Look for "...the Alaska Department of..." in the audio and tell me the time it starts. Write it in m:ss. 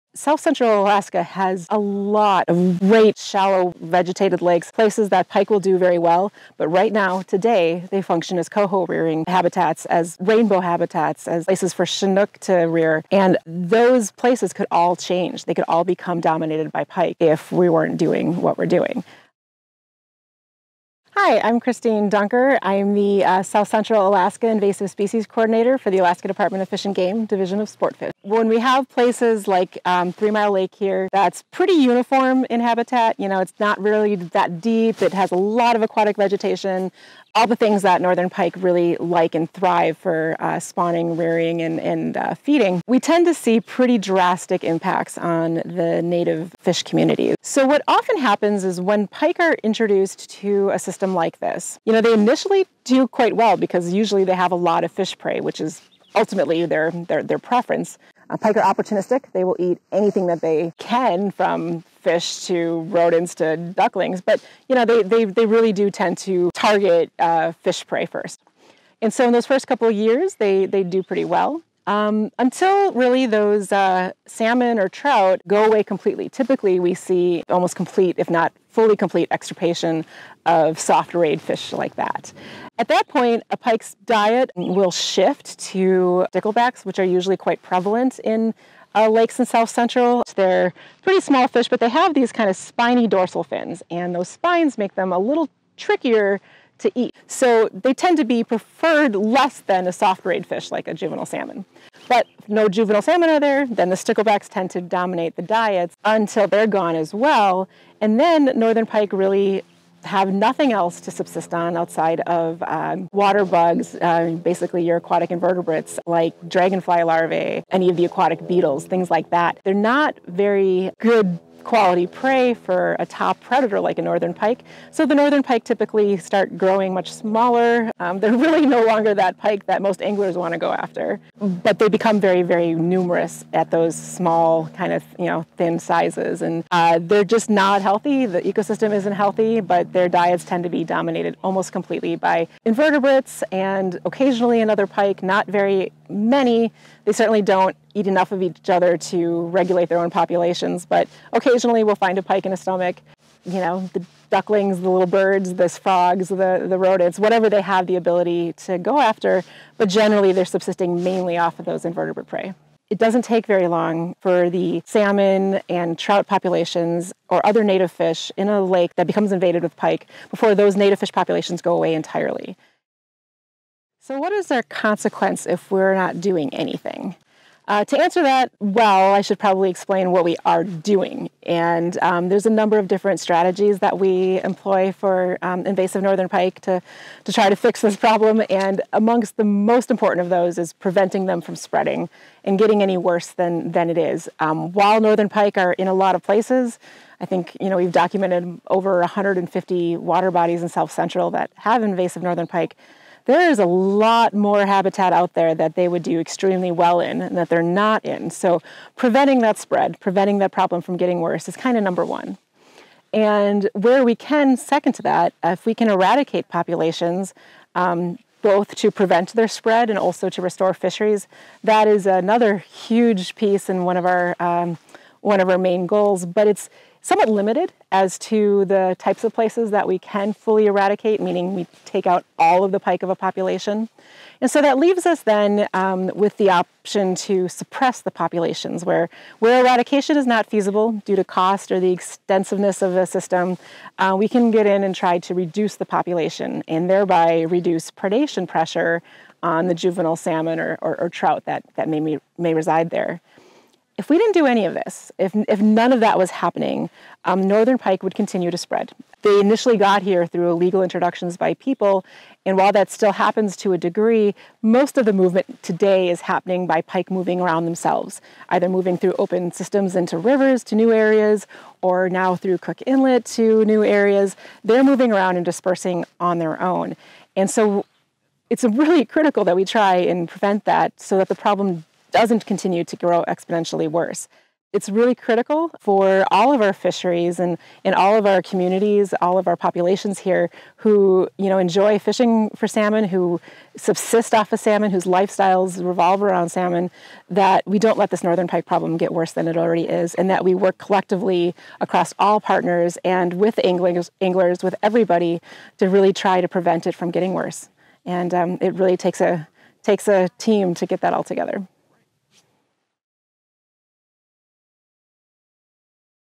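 0:25.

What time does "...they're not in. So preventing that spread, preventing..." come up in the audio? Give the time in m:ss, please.
3:27.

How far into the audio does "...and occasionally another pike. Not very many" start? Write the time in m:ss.
2:23.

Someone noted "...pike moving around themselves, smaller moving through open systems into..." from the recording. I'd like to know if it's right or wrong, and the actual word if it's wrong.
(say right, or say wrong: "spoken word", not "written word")
wrong: "either", not "smaller".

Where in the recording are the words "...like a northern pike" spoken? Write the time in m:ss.
2:03.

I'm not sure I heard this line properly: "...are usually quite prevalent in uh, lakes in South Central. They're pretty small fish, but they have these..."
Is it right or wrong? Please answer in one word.
right.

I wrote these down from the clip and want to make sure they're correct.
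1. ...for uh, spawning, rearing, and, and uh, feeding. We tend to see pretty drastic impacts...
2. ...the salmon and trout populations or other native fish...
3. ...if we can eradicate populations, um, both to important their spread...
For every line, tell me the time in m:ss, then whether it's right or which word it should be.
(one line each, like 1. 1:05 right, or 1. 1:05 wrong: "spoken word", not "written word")
1. 0:39 right
2. 2:44 right
3. 3:35 wrong: "prevent", not "important".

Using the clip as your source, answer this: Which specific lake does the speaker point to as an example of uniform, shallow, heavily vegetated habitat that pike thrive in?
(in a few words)
Three Mile Lake.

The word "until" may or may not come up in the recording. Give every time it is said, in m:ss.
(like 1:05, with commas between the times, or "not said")
1:12, 1:46.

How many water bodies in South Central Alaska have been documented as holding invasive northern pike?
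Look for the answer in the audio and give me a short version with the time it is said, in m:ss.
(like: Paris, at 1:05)
Over 150, at 3:18.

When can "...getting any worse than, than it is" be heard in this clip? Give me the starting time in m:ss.
3:12.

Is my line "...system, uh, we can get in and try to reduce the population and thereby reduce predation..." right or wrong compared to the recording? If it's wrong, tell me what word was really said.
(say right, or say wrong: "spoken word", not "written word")
right.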